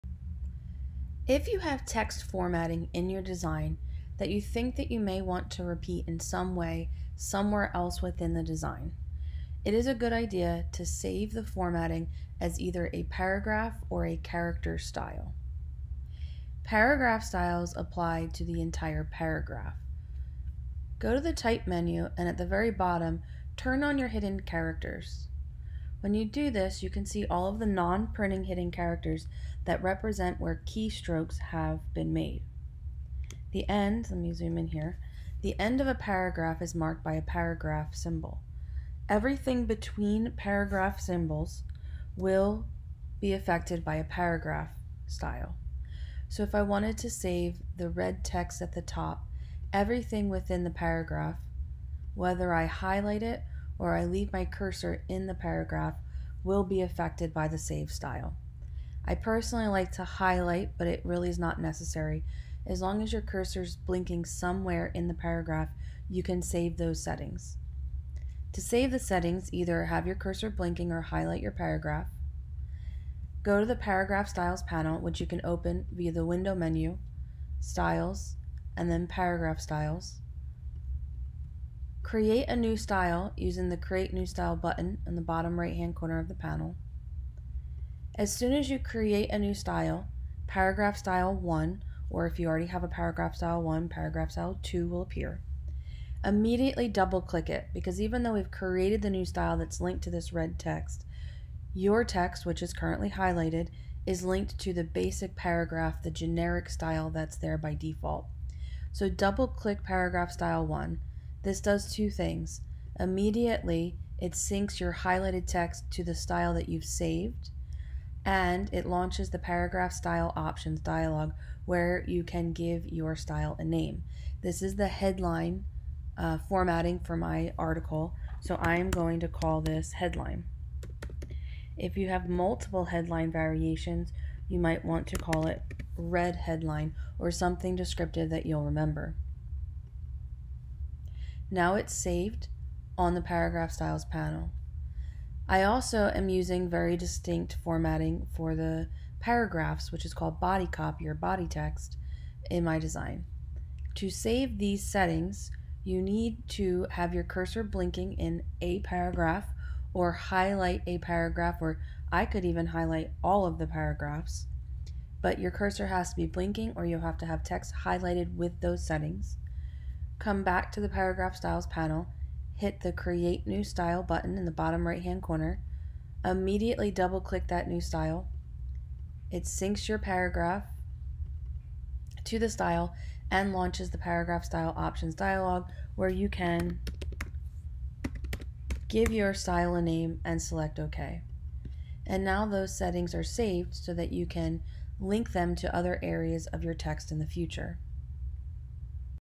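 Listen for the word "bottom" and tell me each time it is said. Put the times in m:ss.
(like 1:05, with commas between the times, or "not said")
0:22, 1:25, 2:54.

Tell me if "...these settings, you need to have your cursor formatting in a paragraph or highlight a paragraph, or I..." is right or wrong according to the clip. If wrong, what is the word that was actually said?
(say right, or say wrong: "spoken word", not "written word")
wrong: "blinking", not "formatting".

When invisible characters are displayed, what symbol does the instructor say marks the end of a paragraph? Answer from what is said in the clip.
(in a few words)
paragraph symbol.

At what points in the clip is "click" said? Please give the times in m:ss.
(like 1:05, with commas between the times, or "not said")
1:37, 1:49, 2:57.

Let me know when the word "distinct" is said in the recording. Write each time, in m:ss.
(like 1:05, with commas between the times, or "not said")
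2:26.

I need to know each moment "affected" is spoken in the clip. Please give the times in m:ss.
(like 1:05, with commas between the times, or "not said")
0:43, 0:56.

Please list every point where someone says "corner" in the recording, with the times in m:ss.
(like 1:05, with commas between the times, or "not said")
1:25, 2:55.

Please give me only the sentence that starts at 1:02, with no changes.
As long as your cursor is blinking somewhere in the paragraph, you can save those settings.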